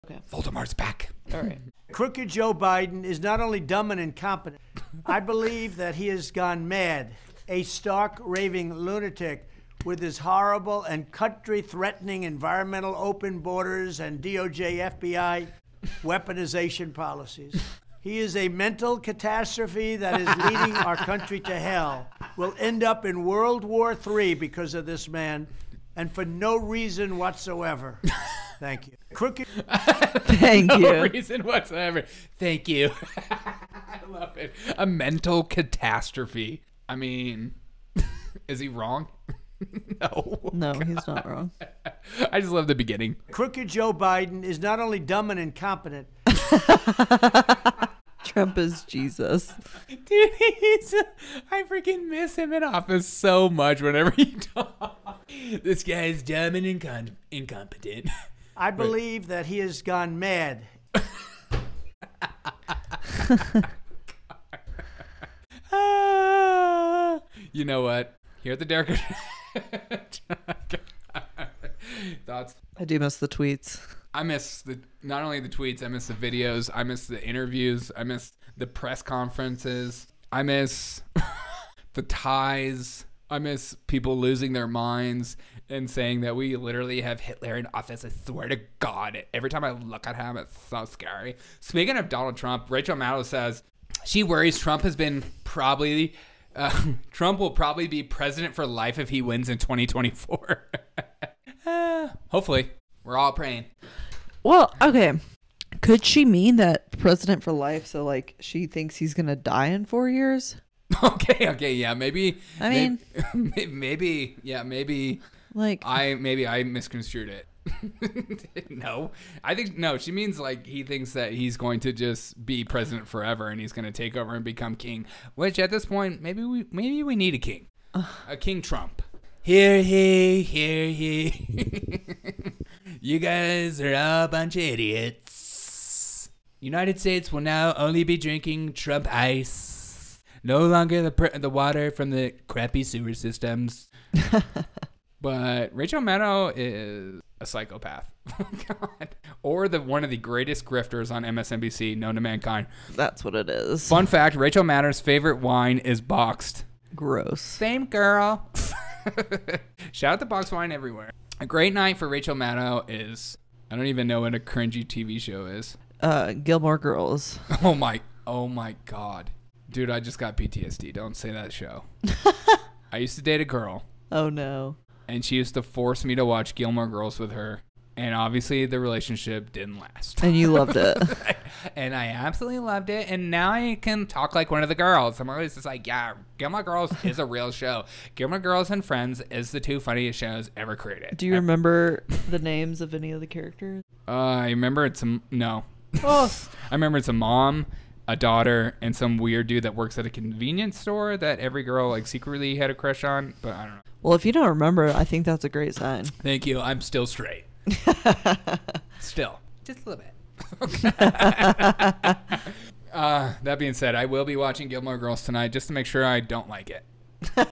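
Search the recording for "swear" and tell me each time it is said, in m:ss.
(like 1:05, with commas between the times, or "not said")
1:28.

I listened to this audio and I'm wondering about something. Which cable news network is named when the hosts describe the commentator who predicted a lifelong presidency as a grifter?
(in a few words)
MSNBC.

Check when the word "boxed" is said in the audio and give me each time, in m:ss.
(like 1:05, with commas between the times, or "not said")
2:36, 2:40.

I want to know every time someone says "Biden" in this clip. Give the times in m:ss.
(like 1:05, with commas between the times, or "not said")
0:02, 0:43.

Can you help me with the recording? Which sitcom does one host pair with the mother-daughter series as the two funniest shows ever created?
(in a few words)
Friends.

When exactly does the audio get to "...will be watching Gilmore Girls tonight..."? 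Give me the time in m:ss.
3:34.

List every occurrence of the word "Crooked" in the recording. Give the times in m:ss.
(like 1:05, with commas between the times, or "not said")
0:01, 0:29, 0:43.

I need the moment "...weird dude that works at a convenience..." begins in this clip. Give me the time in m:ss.
3:19.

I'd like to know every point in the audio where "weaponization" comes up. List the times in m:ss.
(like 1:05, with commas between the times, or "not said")
0:16.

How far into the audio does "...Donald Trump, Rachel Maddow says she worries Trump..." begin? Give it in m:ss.
1:32.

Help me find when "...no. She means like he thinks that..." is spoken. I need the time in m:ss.
1:59.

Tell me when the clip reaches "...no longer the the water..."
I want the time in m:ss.
2:20.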